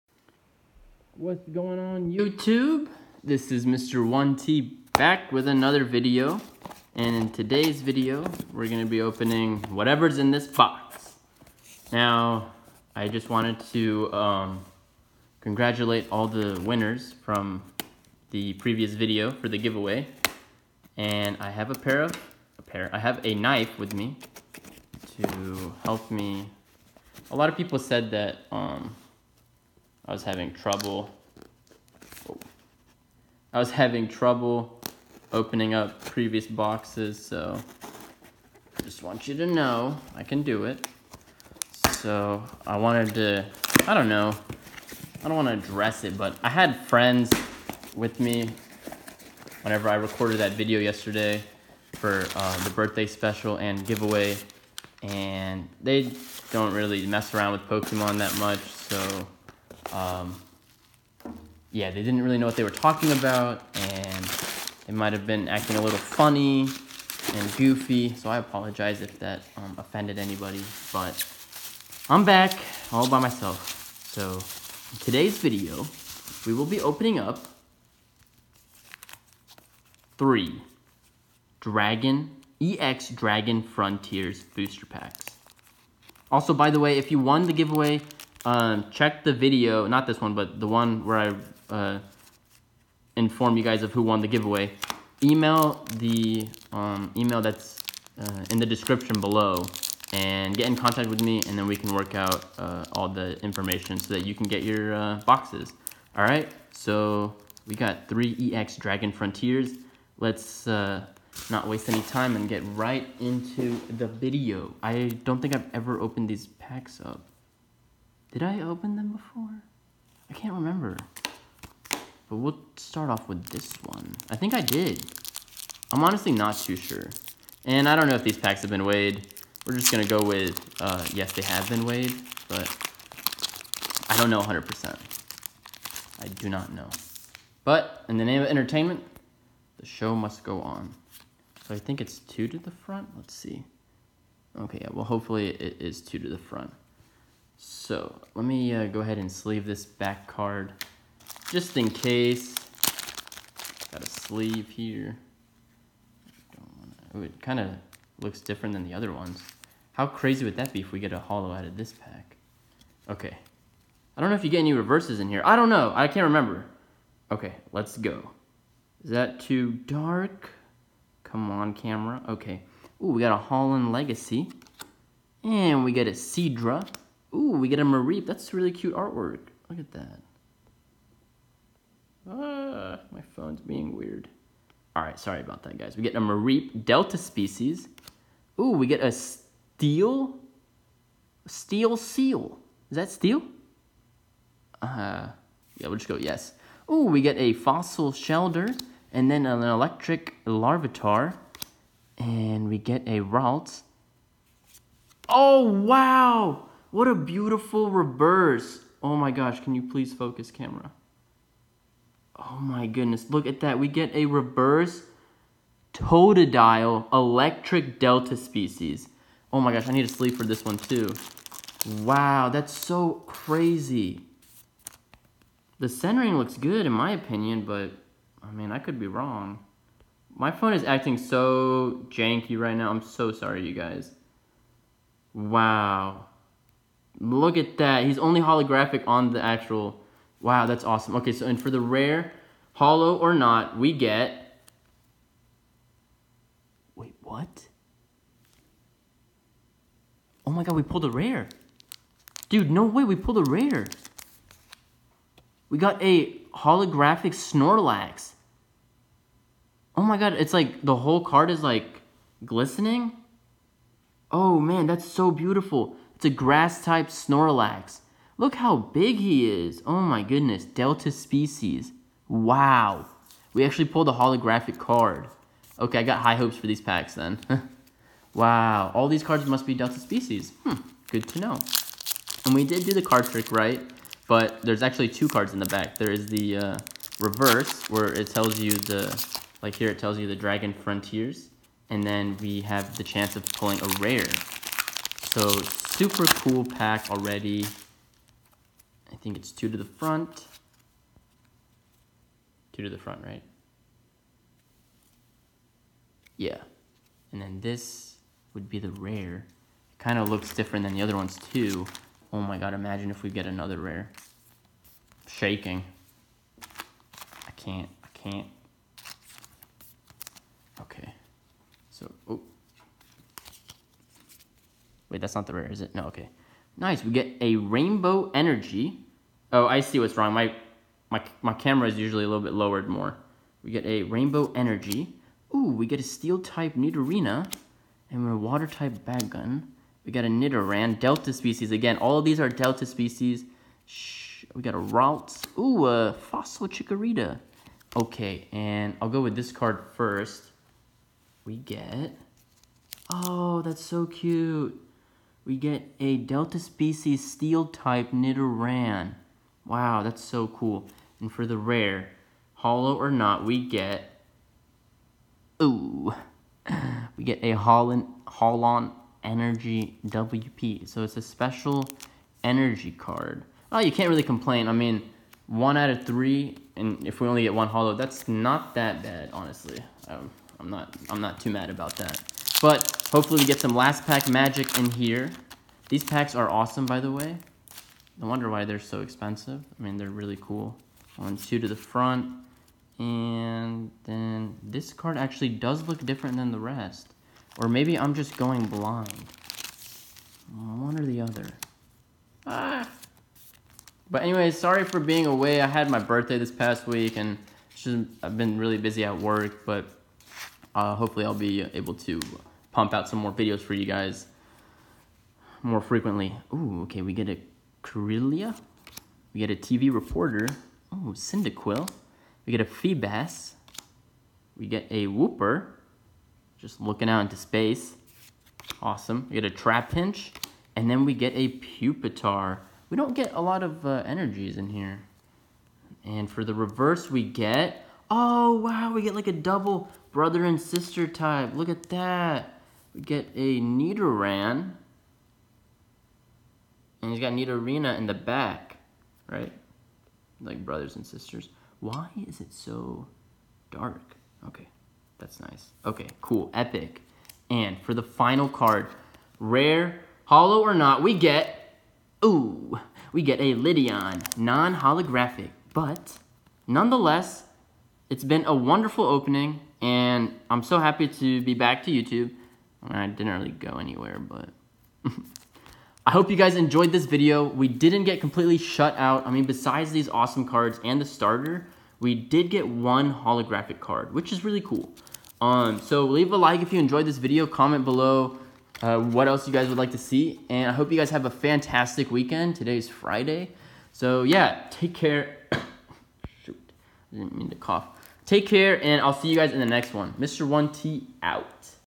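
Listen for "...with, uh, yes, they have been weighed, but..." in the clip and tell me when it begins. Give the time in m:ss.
2:10.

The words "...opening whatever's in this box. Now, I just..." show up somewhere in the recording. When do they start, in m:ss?
0:09.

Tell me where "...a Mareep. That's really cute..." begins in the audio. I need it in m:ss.
2:57.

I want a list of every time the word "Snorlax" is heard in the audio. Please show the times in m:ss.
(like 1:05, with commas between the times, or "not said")
4:17, 4:27.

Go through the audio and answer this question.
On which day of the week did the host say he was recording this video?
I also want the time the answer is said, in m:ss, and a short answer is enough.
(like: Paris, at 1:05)
Friday, at 8:12.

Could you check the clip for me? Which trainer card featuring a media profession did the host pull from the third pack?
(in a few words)
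TV reporter.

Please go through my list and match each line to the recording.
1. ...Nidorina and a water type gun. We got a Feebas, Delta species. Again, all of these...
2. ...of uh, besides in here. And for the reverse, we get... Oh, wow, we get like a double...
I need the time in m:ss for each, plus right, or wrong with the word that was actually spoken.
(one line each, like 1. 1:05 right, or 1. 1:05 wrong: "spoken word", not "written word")
1. 5:36 wrong: "Nidoran", not "Feebas"
2. 7:13 wrong: "energies", not "besides".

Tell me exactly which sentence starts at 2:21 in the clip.
So I think it's two to the front.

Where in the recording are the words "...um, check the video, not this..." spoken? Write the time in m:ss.
1:28.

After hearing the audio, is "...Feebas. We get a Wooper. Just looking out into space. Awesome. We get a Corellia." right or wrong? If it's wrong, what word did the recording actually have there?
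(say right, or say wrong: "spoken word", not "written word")
wrong: "Trapinch", not "Corellia".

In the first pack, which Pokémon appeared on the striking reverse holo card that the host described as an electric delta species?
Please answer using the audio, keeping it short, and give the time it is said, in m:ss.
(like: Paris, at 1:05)
Totodile, at 3:35.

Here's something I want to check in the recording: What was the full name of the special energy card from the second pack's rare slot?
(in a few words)
Holon Energy WP.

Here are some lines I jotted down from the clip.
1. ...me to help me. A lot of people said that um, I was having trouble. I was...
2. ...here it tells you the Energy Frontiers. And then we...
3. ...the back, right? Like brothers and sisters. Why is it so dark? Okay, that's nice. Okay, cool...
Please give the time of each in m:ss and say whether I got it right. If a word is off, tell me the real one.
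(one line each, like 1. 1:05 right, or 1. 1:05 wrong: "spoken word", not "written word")
1. 0:23 right
2. 4:49 wrong: "Dragon", not "Energy"
3. 7:28 right.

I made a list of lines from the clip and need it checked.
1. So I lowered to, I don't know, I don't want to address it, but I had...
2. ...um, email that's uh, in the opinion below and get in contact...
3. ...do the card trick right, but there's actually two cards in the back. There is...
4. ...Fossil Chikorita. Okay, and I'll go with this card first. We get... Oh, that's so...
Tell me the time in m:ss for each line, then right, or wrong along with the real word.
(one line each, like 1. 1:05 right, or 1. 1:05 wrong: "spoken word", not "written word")
1. 0:41 wrong: "wanted", not "lowered"
2. 1:36 wrong: "description", not "opinion"
3. 4:42 right
4. 5:46 right.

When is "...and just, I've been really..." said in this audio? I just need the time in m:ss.
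6:47.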